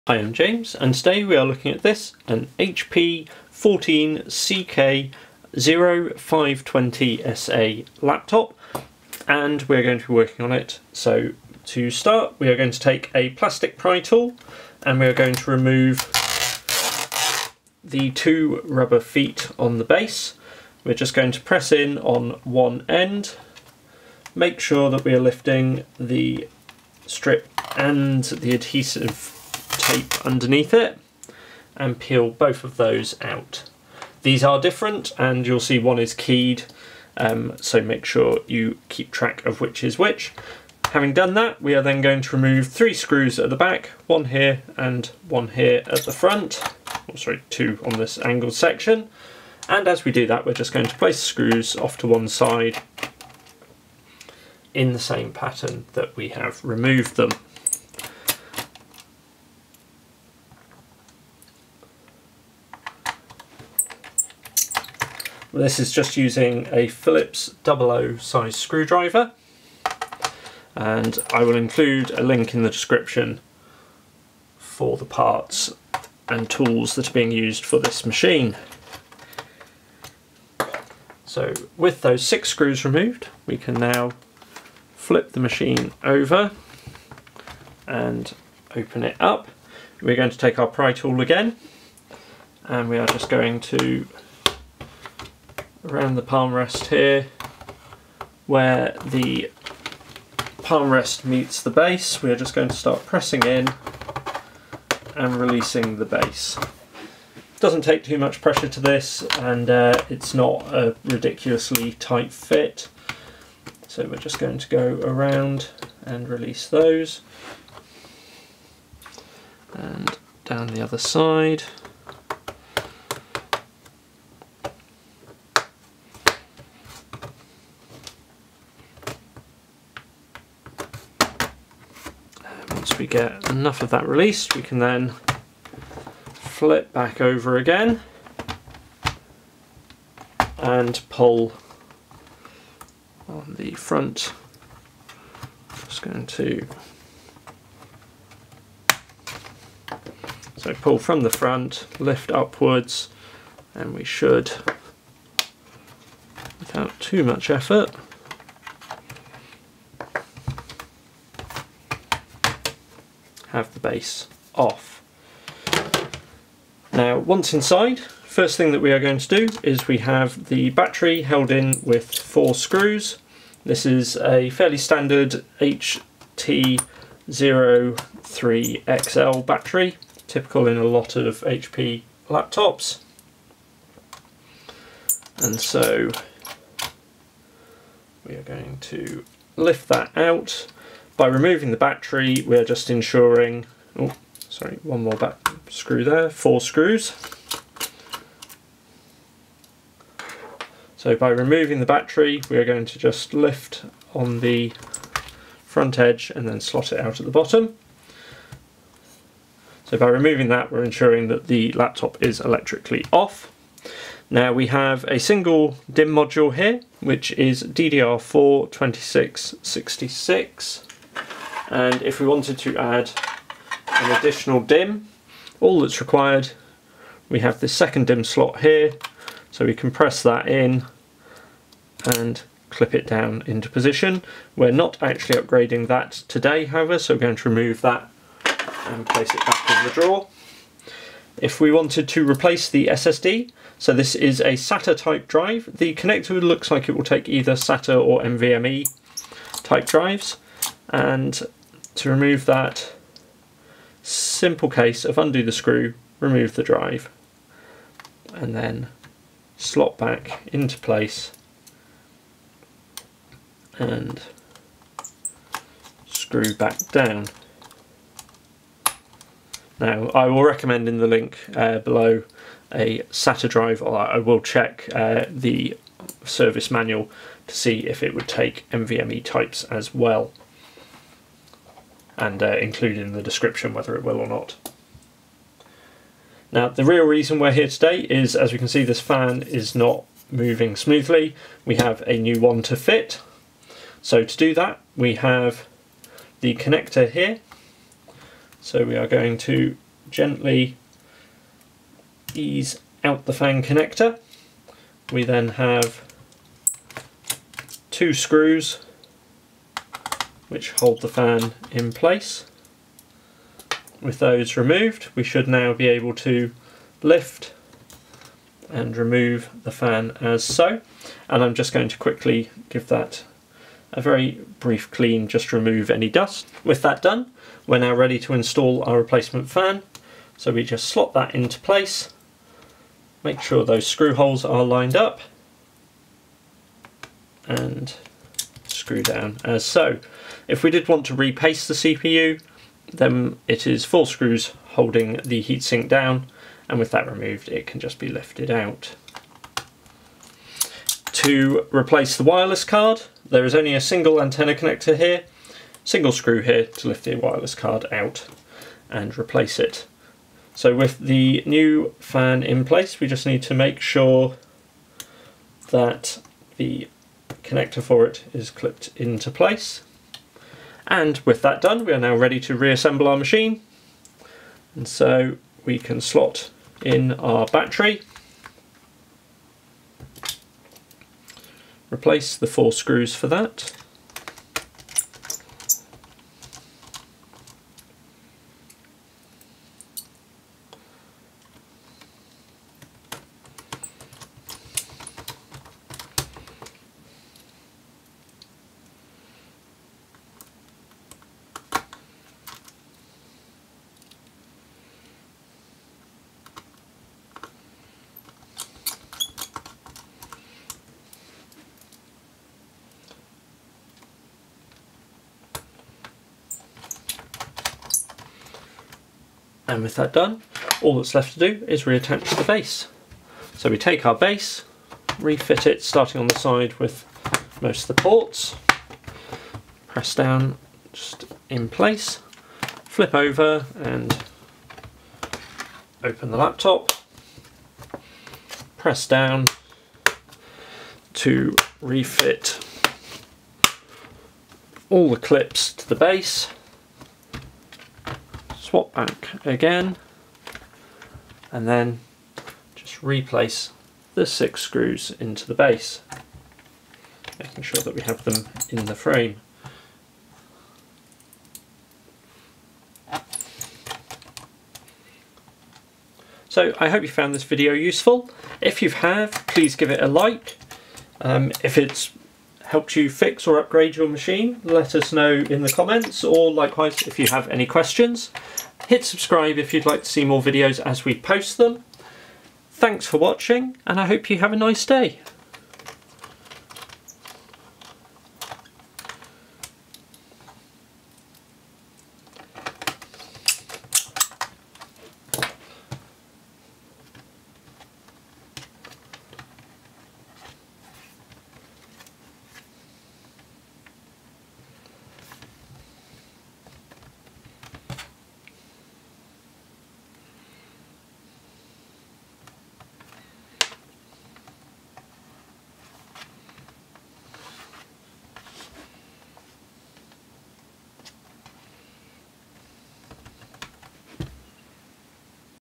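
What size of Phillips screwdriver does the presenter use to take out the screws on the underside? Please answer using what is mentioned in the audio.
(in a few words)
00.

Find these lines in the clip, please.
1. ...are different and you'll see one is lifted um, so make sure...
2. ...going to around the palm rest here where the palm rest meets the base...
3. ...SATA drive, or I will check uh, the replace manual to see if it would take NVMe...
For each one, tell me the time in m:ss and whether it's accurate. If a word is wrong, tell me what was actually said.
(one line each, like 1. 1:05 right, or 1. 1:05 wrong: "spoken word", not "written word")
1. 0:34 wrong: "keyed", not "lifted"
2. 1:33 right
3. 4:33 wrong: "service", not "replace".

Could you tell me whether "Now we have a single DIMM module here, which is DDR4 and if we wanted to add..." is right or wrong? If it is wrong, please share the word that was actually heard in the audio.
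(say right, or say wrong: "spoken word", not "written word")
right.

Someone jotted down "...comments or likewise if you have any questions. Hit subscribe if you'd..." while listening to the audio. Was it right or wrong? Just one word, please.
right.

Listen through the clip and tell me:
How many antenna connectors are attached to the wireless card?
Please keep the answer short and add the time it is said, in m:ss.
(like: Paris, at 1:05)
1, at 5:53.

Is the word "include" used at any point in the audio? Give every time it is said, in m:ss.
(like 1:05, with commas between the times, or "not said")
1:11, 4:42.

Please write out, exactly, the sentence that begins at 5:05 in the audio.
We then have two screws which hold the fan in place.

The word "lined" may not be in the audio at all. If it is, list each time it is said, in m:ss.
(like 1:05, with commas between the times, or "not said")
5:34.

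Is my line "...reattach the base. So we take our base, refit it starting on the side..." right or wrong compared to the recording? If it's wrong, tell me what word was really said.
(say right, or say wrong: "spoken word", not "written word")
right.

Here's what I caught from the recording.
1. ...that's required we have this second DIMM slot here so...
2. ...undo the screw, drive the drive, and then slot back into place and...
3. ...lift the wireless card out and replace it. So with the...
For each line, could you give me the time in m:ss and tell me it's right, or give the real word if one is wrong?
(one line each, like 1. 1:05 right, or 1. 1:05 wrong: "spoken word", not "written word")
1. 3:45 right
2. 4:15 wrong: "remove", not "drive"
3. 5:56 right.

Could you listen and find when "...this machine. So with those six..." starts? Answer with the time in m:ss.
1:17.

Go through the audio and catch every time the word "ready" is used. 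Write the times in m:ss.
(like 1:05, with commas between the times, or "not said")
5:27, 6:12.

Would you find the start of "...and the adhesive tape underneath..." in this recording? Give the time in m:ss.
0:27.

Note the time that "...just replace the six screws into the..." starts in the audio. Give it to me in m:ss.
7:32.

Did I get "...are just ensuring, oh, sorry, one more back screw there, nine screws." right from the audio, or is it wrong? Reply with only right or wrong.
wrong.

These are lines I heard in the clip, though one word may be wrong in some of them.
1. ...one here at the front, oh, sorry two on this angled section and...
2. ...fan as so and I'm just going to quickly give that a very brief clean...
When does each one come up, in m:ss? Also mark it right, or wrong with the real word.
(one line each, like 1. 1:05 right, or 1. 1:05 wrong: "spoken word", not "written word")
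1. 0:45 right
2. 5:19 right.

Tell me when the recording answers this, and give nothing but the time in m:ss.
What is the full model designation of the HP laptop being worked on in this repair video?
0:03.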